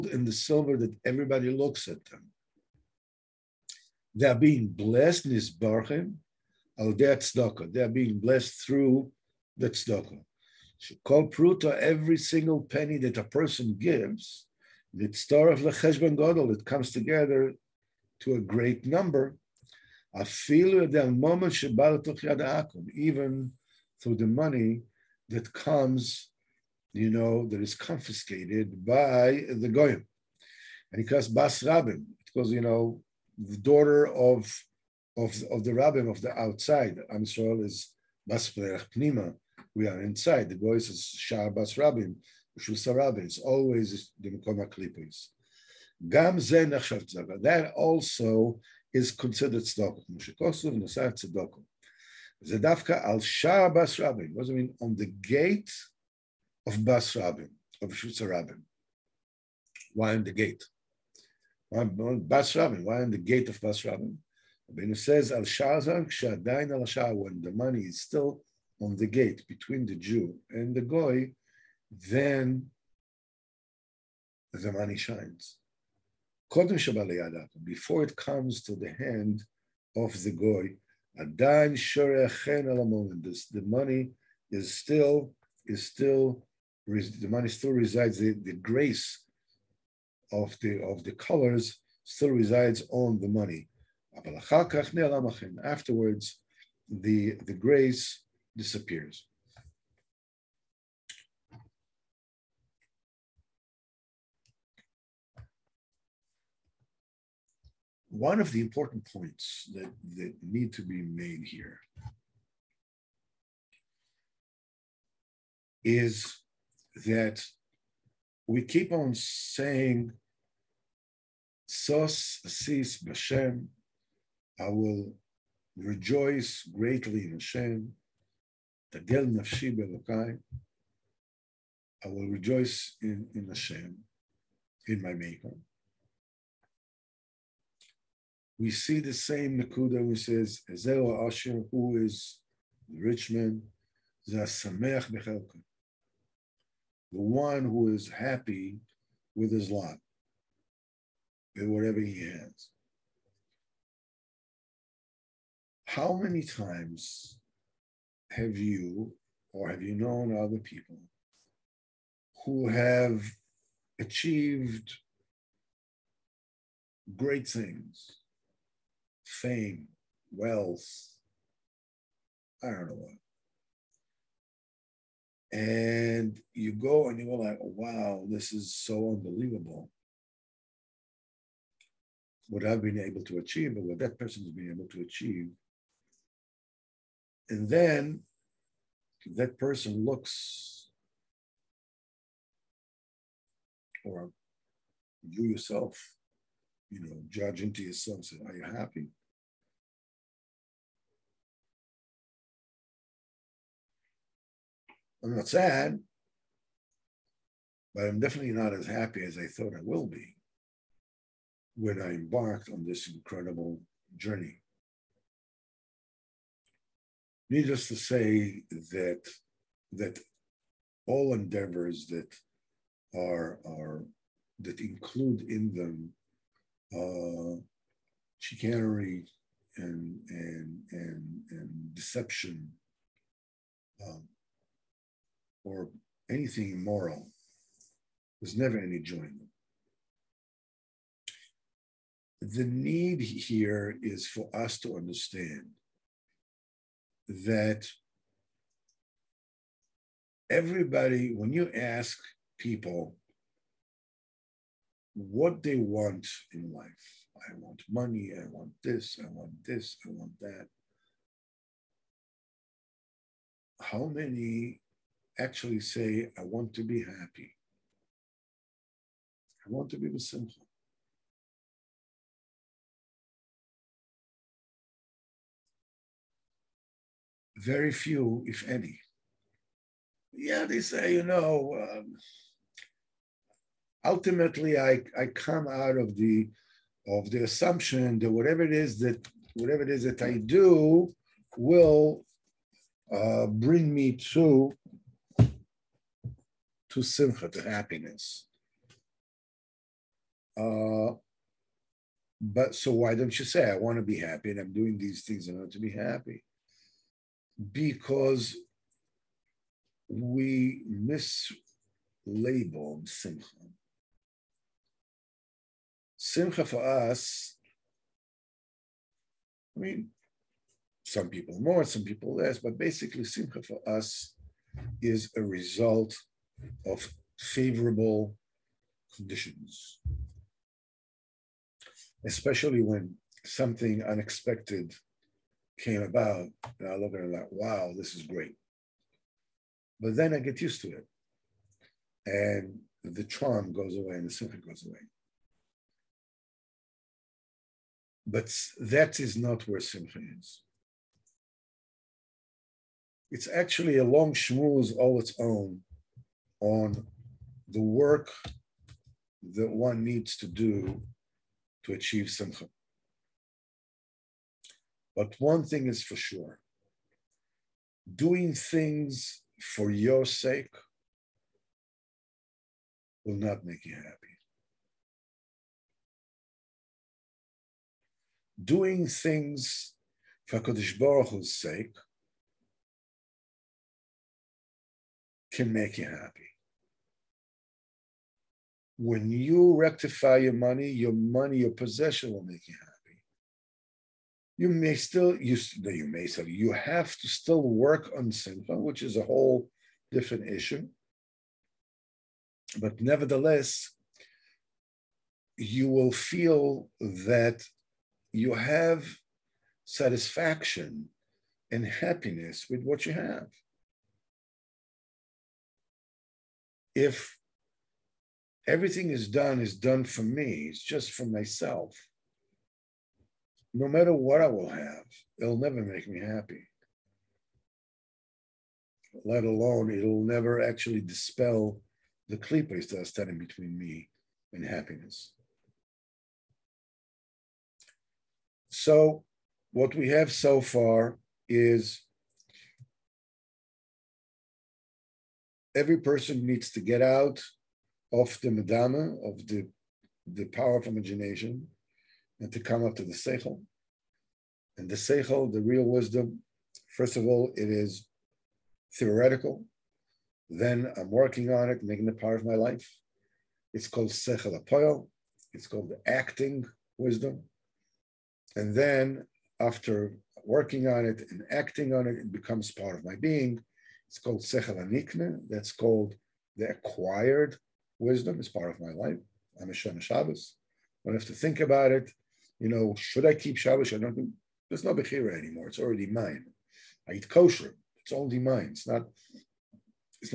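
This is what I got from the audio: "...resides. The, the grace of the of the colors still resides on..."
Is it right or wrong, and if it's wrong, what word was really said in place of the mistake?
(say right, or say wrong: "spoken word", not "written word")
right.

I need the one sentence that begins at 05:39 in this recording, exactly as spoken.
But then I get used to it, and the charm goes away, and the simcha goes away.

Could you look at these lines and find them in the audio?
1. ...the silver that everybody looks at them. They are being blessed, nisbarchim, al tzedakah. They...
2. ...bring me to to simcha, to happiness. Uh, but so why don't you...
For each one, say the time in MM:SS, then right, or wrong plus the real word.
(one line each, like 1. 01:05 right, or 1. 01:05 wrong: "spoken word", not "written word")
1. 00:00 right
2. 04:53 right.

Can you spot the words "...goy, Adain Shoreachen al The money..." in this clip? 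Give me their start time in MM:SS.
01:20.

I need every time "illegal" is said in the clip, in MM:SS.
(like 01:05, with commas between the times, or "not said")
not said.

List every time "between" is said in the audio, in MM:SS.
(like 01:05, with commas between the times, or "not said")
01:09, 07:13.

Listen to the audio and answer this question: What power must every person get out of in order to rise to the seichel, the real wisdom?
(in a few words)
power of imagination.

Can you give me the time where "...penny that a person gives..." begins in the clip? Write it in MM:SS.
00:12.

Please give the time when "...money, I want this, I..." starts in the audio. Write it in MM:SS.
04:17.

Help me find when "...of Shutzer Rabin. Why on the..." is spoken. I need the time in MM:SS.
00:57.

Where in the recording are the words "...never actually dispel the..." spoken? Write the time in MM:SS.
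07:10.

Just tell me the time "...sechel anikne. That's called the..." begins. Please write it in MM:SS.
07:54.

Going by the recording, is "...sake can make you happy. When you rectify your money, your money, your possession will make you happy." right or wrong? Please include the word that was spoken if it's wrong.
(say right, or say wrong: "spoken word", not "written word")
right.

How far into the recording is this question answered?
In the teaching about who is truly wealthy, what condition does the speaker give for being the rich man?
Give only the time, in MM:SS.
02:27.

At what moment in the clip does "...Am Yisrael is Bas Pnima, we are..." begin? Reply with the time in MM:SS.
00:37.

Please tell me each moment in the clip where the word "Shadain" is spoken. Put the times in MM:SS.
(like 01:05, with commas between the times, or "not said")
01:06.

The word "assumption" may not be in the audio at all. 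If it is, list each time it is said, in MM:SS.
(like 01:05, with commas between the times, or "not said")
04:47.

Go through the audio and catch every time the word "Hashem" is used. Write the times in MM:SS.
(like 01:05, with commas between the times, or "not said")
02:07, 02:13.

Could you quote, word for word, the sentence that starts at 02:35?
How many times have you or have you known other people who have achieved great things?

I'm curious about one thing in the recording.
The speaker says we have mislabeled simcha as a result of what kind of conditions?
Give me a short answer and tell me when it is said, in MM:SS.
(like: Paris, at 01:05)
favorable conditions, at 05:27.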